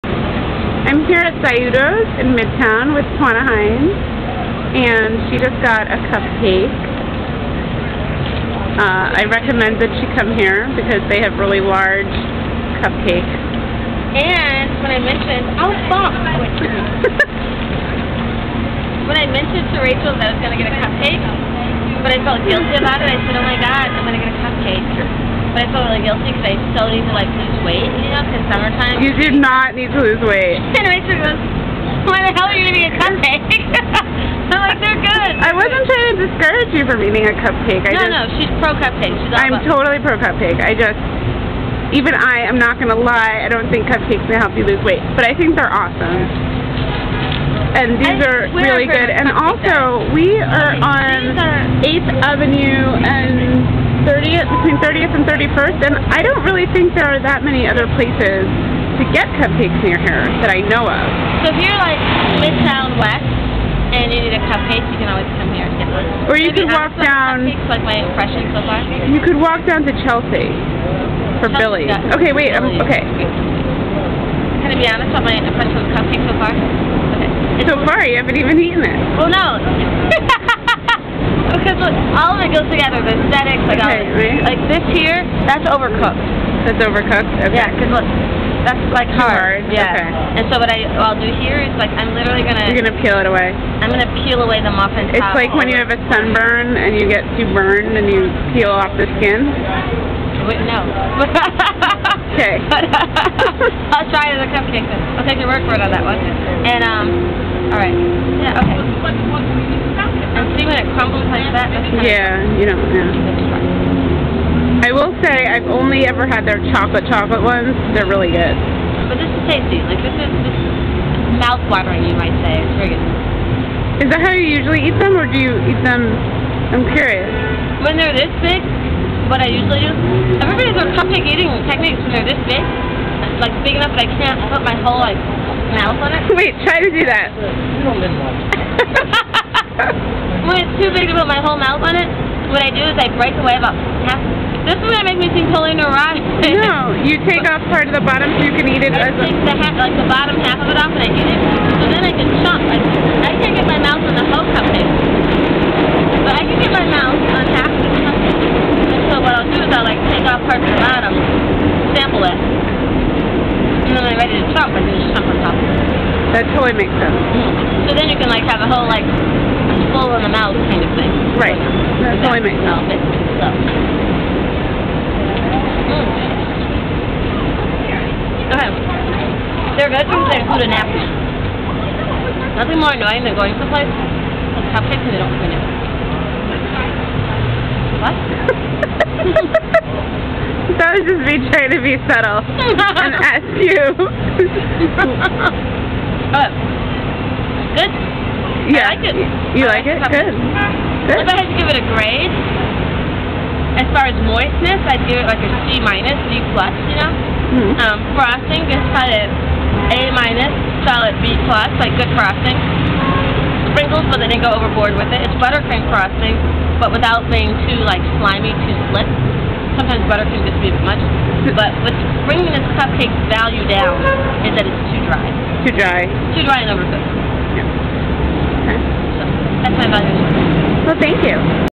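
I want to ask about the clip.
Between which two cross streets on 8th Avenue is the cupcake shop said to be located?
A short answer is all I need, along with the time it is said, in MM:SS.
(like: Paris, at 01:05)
30th and 31st, at 00:54.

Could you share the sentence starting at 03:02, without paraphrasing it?
Nothing more annoying than going someplace with cupcakes and they don't clean it.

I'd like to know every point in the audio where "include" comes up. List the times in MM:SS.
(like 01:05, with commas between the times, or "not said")
03:00.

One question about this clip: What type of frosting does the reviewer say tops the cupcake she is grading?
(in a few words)
Buttercream.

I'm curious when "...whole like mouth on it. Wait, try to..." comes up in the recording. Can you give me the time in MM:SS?
02:14.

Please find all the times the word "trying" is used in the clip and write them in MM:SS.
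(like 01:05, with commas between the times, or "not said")
00:35, 03:11.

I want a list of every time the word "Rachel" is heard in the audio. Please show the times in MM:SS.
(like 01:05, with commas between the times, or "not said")
00:19, 00:30.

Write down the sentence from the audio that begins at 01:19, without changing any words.
Well, no all of it goes together.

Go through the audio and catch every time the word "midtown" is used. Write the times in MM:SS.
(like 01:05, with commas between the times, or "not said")
00:02, 01:02.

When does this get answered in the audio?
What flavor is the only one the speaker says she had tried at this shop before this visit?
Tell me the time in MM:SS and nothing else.
01:56.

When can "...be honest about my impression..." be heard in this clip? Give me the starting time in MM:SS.
01:14.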